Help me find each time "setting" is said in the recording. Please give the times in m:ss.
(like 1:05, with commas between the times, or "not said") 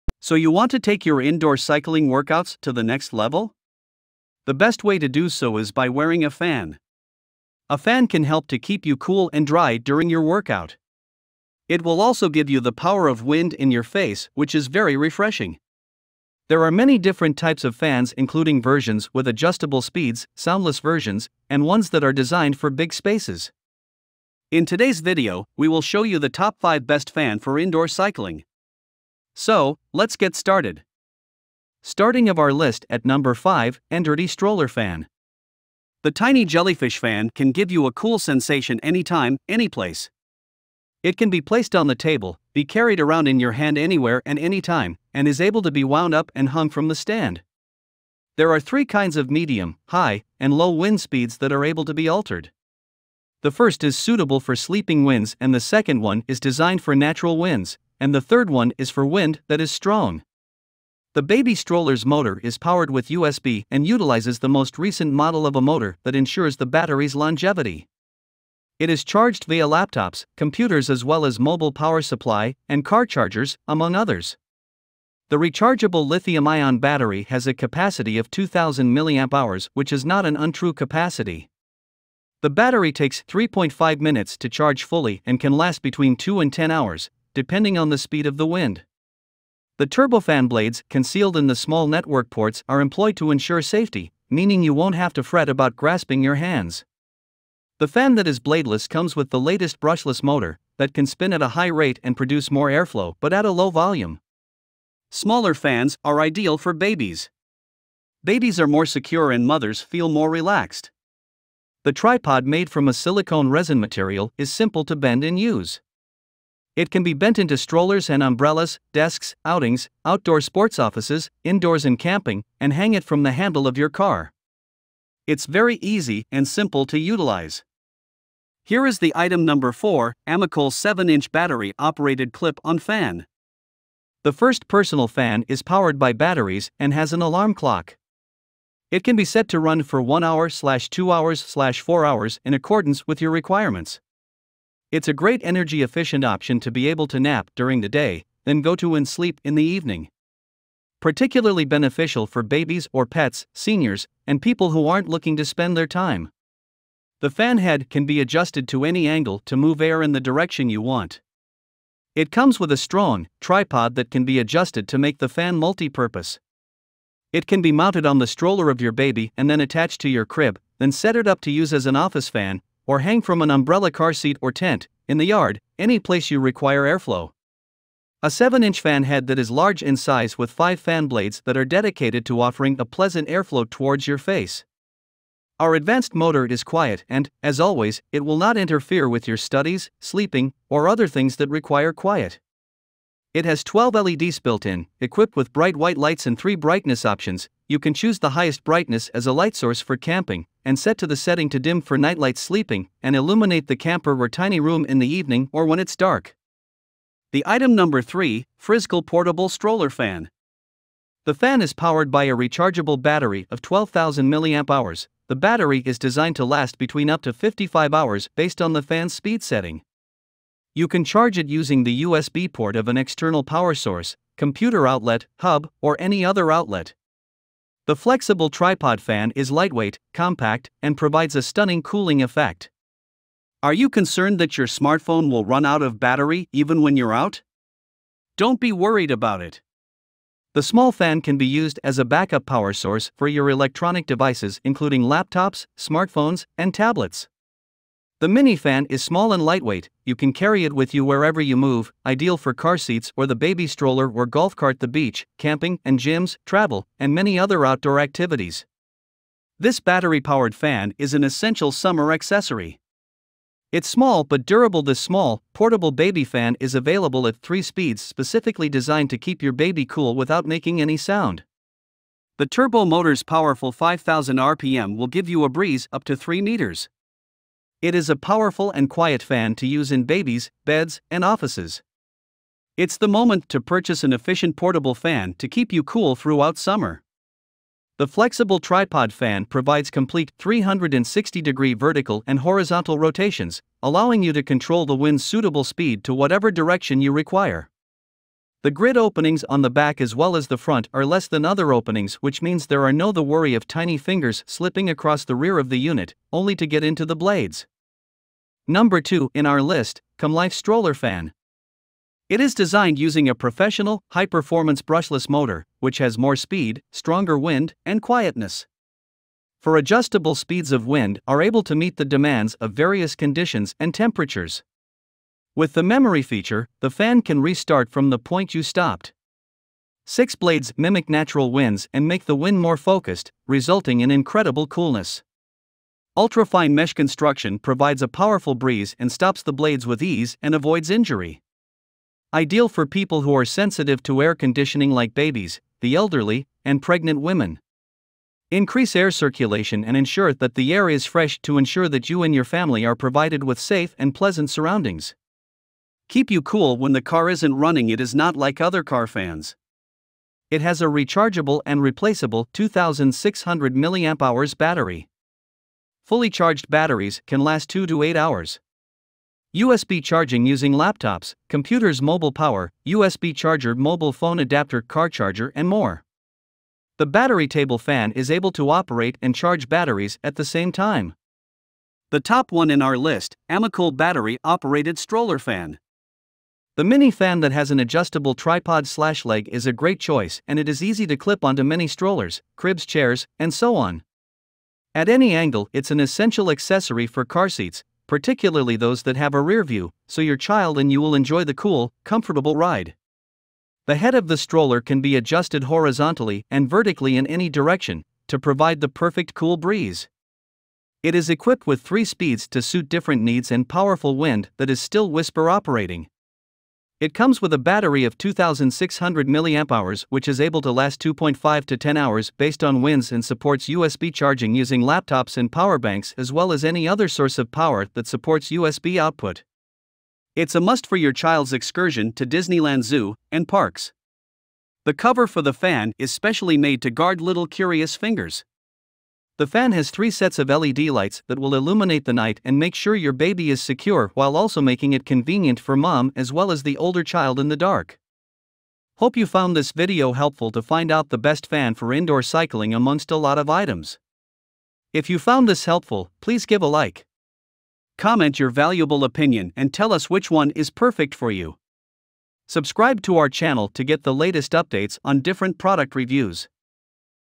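3:21, 3:39.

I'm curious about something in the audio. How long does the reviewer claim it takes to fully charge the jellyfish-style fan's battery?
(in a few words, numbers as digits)
3.5 minutes.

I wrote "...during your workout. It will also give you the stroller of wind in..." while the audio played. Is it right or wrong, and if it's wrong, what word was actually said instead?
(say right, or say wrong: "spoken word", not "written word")
wrong: "power", not "stroller".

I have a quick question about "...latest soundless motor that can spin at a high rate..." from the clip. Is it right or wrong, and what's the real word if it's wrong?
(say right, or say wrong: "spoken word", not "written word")
wrong: "brushless", not "soundless".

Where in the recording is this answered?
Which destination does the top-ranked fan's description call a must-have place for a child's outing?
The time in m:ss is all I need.
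7:12.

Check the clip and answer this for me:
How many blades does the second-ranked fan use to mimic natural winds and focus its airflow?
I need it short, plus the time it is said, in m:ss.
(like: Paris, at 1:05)
Six, at 5:30.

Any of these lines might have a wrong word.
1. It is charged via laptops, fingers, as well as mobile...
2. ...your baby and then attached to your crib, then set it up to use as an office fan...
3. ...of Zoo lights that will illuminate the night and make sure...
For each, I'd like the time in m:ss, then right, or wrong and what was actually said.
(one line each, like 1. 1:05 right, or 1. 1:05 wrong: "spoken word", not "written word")
1. 1:08 wrong: "computers", not "fingers"
2. 2:48 right
3. 7:20 wrong: "LED", not "Zoo".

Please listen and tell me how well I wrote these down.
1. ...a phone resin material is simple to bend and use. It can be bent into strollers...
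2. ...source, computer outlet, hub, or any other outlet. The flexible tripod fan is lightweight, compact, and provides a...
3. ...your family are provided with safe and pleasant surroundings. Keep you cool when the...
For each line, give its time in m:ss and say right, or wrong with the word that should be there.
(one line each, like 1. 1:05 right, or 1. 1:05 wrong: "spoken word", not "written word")
1. 1:52 wrong: "silicone", not "phone"
2. 3:43 right
3. 5:52 right.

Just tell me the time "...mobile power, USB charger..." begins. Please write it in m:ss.
6:12.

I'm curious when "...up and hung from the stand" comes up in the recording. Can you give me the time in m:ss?
0:46.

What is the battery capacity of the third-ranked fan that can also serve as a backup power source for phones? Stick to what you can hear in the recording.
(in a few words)
12,000 mAh.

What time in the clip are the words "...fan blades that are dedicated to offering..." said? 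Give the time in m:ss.
3:00.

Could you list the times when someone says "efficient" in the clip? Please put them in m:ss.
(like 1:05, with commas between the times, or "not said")
2:25, 4:44.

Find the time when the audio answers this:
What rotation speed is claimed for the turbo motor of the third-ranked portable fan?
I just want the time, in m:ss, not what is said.
4:33.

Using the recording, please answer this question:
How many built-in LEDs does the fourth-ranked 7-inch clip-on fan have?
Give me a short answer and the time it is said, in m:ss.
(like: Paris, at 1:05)
12, at 3:13.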